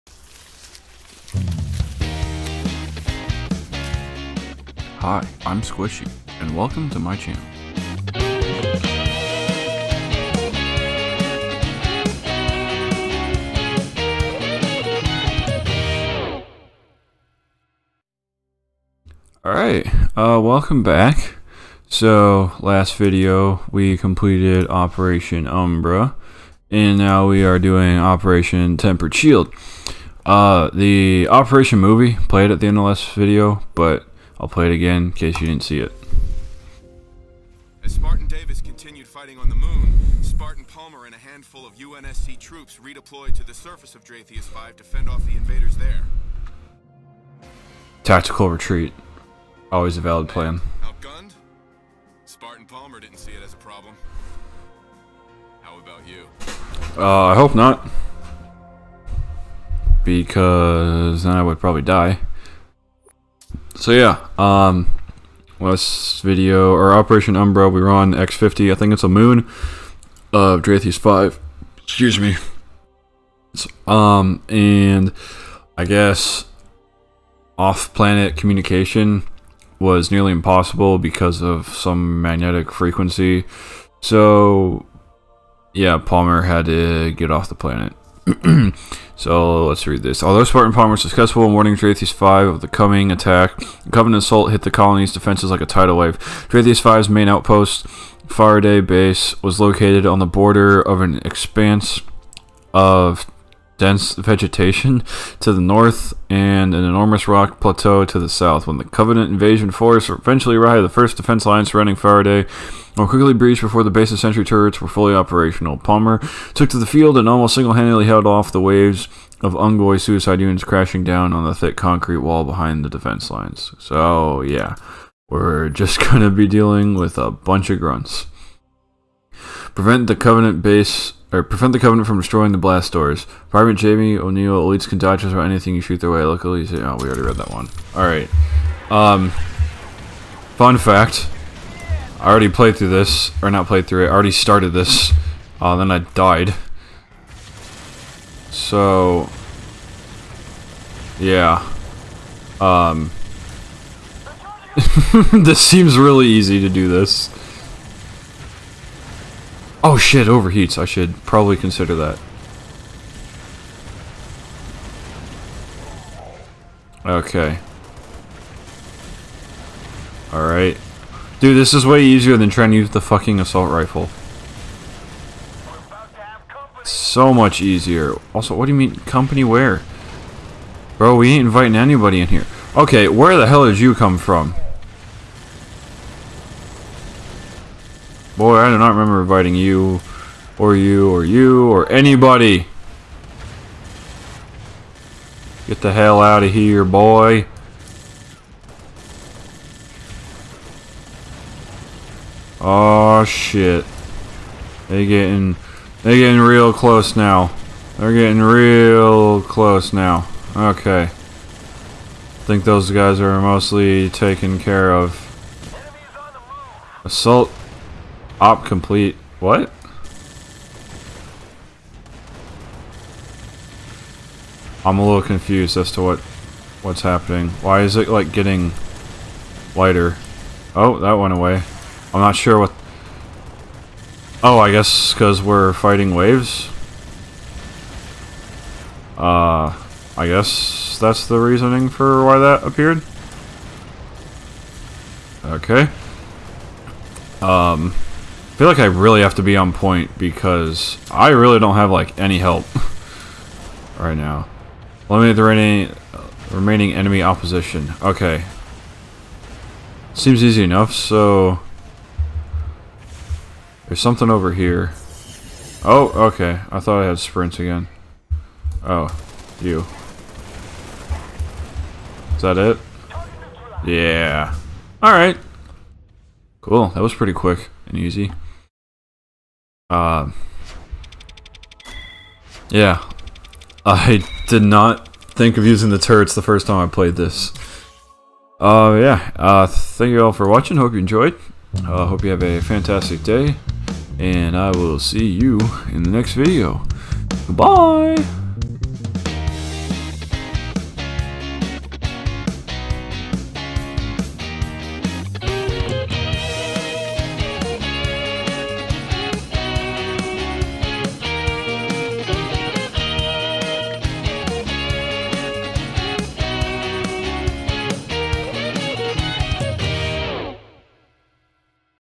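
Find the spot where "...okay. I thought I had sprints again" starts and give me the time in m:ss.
4:26.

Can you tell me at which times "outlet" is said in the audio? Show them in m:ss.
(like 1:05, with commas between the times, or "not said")
not said.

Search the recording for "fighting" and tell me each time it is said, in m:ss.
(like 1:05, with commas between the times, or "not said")
0:39, 3:55.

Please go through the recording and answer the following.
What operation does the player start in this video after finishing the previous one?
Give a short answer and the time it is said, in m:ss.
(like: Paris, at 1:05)
Operation Tempered Shield, at 0:27.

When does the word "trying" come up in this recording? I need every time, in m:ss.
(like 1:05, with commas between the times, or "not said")
2:52.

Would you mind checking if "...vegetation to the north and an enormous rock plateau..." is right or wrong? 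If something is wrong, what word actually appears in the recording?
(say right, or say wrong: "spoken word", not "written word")
right.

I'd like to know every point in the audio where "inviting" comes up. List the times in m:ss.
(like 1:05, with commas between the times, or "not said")
3:01, 3:09.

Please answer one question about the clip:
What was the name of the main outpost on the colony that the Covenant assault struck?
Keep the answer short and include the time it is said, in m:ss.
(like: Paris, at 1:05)
Faraday Base, at 1:38.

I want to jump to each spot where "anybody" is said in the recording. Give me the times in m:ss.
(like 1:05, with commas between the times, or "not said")
3:01, 3:11.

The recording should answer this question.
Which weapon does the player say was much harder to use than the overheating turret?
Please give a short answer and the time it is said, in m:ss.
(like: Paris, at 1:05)
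assault rifle, at 2:53.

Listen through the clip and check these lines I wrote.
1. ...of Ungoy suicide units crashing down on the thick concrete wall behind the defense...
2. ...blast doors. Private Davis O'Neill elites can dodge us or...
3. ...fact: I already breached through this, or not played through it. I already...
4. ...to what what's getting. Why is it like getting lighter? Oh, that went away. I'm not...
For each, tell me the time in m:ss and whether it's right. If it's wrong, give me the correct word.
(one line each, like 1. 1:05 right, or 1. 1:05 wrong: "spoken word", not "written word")
1. 1:59 right
2. 2:12 wrong: "Jamie", not "Davis"
3. 2:20 wrong: "played", not "breached"
4. 3:45 wrong: "happening", not "getting".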